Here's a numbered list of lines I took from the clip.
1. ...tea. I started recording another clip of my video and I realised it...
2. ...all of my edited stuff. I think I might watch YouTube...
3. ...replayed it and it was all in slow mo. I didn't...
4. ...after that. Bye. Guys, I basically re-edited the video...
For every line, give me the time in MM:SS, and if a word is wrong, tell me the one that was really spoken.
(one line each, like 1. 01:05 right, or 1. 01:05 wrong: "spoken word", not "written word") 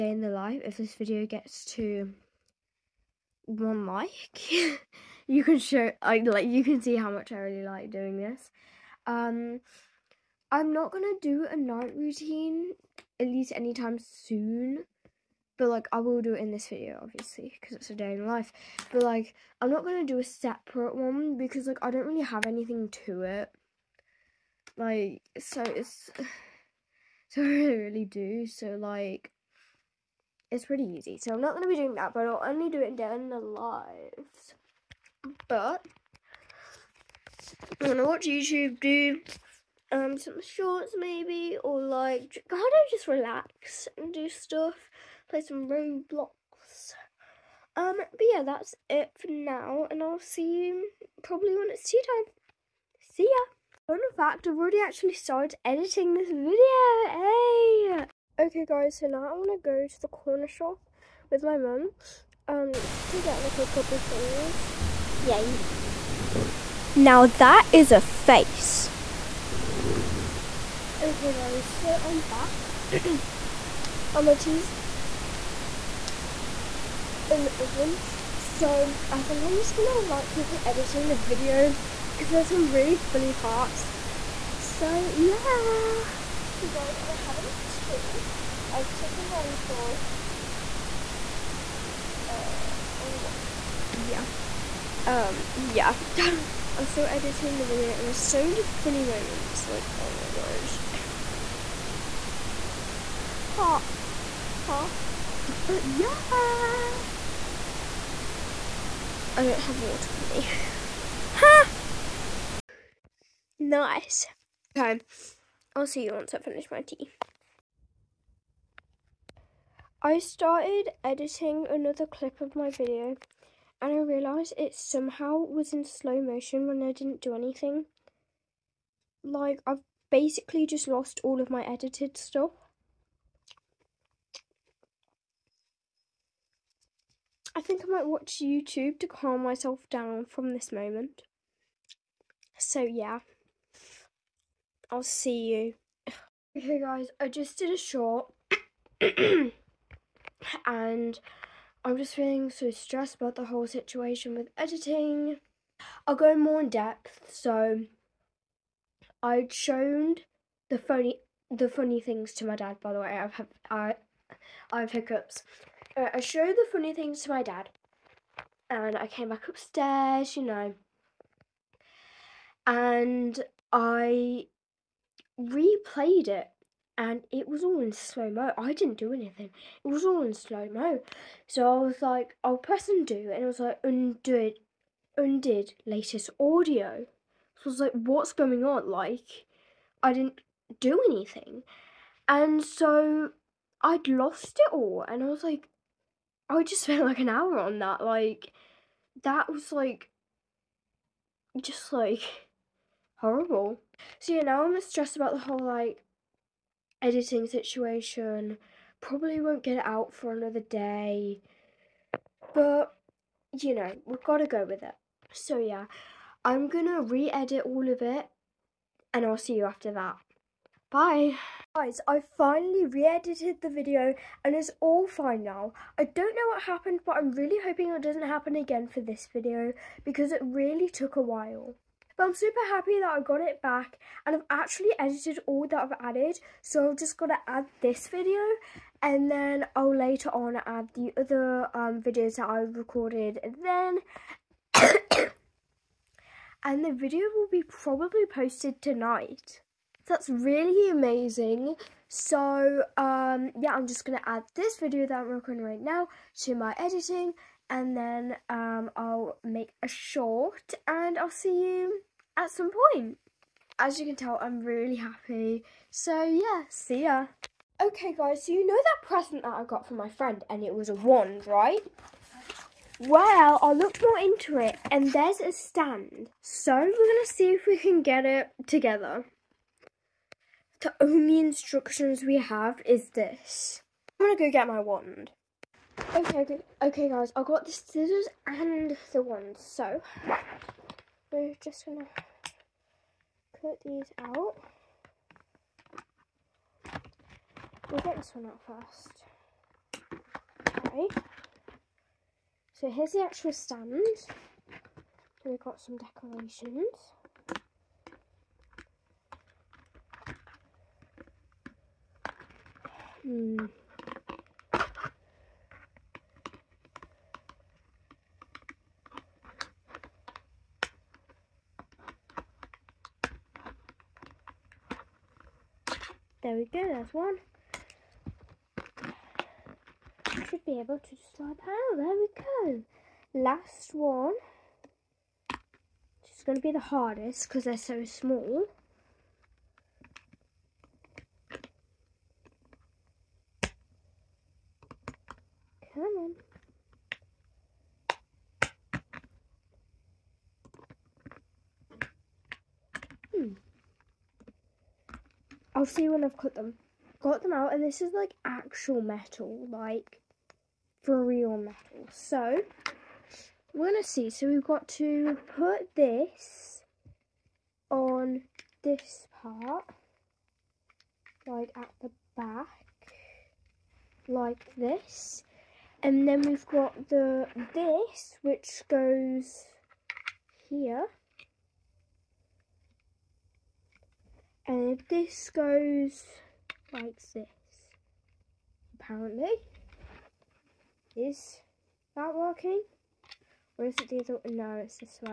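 1. 01:56 wrong: "editing", not "recording"
2. 02:11 right
3. 02:55 right
4. 03:39 wrong: "finally", not "basically".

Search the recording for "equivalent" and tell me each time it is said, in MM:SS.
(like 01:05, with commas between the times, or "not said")
not said.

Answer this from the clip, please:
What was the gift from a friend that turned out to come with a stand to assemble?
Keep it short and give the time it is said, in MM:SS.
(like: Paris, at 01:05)
a wand, at 04:30.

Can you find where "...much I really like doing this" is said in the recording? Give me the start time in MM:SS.
00:07.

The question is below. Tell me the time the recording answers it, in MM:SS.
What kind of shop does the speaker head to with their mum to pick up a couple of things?
01:00.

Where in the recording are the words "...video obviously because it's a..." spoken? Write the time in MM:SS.
00:16.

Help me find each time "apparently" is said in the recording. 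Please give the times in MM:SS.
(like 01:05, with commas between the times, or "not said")
06:28.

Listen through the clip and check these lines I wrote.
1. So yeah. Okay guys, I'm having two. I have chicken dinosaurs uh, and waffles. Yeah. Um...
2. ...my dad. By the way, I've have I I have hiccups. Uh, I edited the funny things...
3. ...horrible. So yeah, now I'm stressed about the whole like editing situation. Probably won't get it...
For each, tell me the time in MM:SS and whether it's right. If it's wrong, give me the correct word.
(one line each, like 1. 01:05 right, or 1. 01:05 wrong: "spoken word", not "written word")
1. 01:24 right
2. 02:42 wrong: "showed", not "edited"
3. 03:23 right.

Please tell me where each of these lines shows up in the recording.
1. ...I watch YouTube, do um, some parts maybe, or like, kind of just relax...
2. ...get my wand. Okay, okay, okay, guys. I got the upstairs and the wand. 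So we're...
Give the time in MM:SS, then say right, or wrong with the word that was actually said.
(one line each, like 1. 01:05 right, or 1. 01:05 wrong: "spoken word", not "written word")
1. 00:37 wrong: "shorts", not "parts"
2. 04:44 wrong: "scissors", not "upstairs".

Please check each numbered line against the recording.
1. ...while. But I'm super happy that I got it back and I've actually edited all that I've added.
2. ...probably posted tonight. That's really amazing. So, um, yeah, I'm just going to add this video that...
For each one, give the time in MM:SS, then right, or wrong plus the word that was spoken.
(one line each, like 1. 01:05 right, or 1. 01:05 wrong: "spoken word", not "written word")
1. 03:51 right
2. 04:07 right.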